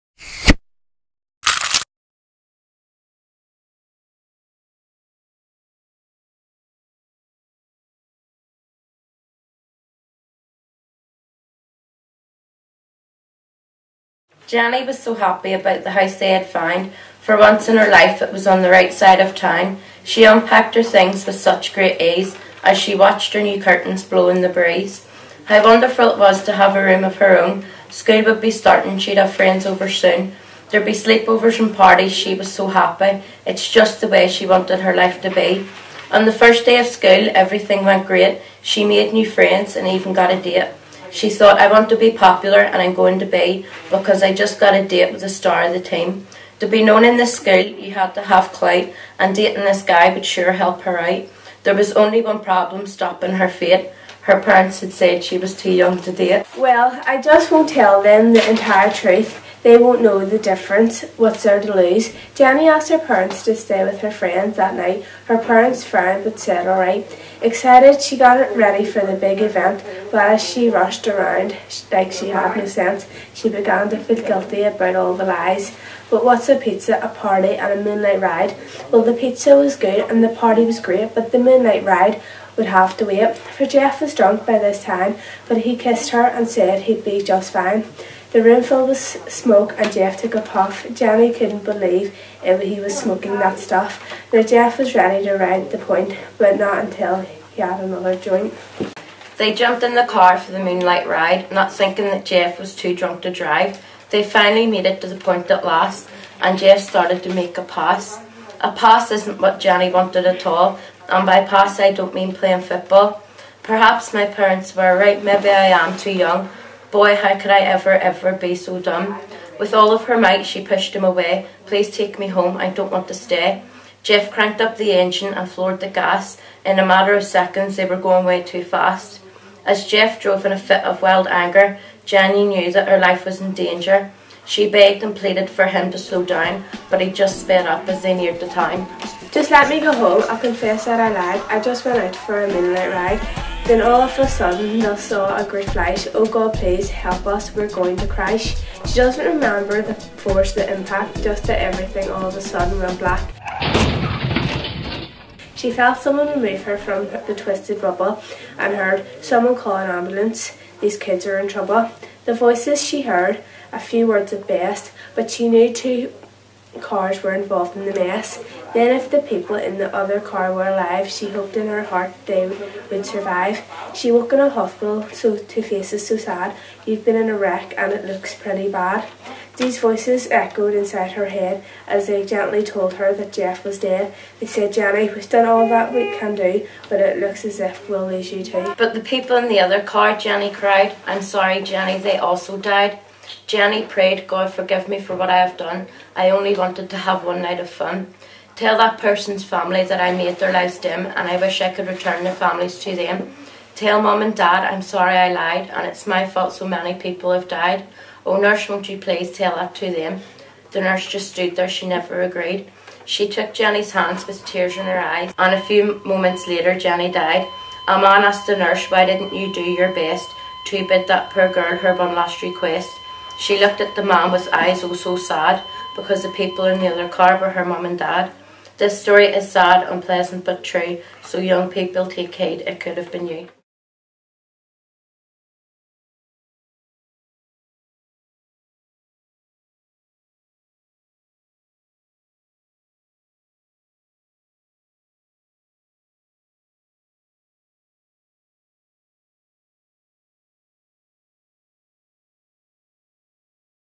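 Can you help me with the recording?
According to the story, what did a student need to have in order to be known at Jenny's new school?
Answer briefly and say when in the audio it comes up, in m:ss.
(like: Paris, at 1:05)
Clout, at 0:48.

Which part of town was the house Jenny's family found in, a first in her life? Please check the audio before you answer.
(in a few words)
The right side.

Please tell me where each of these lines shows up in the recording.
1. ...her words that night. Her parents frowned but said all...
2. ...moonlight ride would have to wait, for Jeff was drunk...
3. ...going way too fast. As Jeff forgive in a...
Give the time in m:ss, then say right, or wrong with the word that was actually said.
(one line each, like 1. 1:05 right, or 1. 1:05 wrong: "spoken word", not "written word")
1. 1:04 wrong: "friends", not "words"
2. 1:21 right
3. 2:07 wrong: "drove", not "forgive".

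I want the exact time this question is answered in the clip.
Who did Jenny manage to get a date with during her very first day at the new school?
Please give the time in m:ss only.
0:45.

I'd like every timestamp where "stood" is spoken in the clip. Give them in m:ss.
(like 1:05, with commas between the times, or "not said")
3:31.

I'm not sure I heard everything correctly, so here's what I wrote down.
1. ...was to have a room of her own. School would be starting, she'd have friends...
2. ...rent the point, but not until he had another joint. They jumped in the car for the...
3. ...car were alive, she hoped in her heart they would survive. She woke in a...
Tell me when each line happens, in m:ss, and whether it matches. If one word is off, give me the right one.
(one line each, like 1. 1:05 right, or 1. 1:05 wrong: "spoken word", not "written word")
1. 0:26 right
2. 1:35 right
3. 2:50 right.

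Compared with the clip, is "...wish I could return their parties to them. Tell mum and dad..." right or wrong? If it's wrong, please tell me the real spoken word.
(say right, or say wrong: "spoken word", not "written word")
wrong: "families", not "parties".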